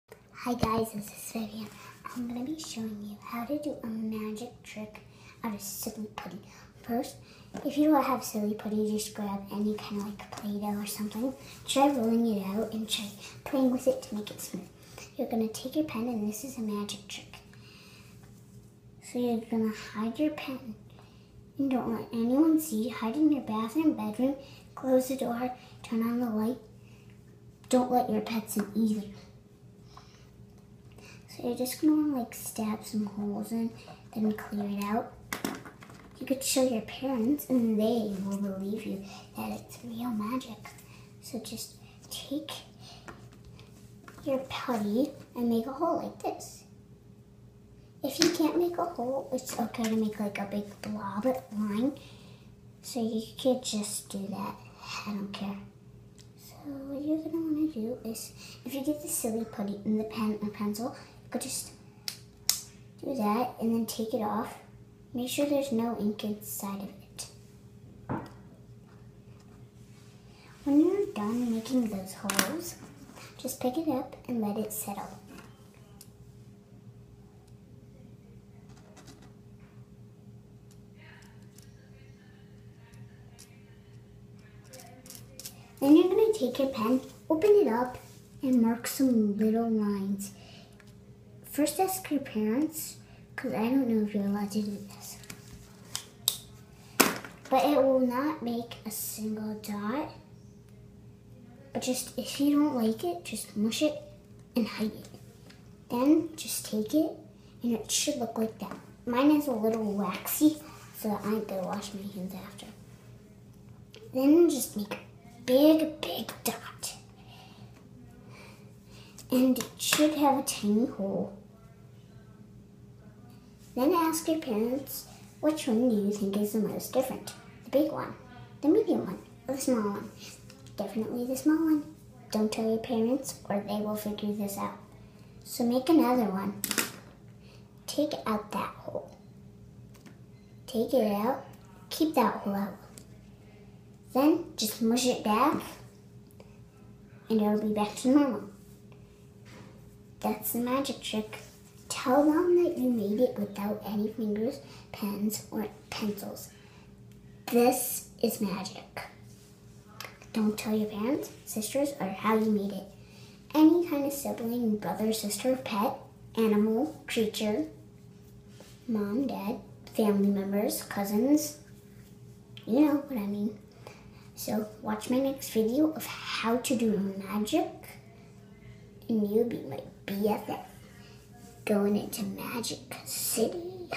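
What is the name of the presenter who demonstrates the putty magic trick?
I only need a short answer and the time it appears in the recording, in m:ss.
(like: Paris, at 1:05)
Vivian, at 0:01.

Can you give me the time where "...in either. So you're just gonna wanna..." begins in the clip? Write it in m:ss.
0:28.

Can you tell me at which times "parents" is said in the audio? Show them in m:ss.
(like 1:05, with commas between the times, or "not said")
0:36, 1:32, 2:04, 2:12, 2:40.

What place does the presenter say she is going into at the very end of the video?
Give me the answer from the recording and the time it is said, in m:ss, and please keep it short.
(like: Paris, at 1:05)
Magic City, at 3:02.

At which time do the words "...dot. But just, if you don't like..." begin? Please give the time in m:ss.
1:39.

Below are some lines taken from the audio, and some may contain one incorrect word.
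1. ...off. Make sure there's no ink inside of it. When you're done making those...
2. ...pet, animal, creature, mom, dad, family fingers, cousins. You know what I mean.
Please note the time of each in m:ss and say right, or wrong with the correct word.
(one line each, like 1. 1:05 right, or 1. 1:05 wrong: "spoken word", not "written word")
1. 1:04 right
2. 2:45 wrong: "members", not "fingers".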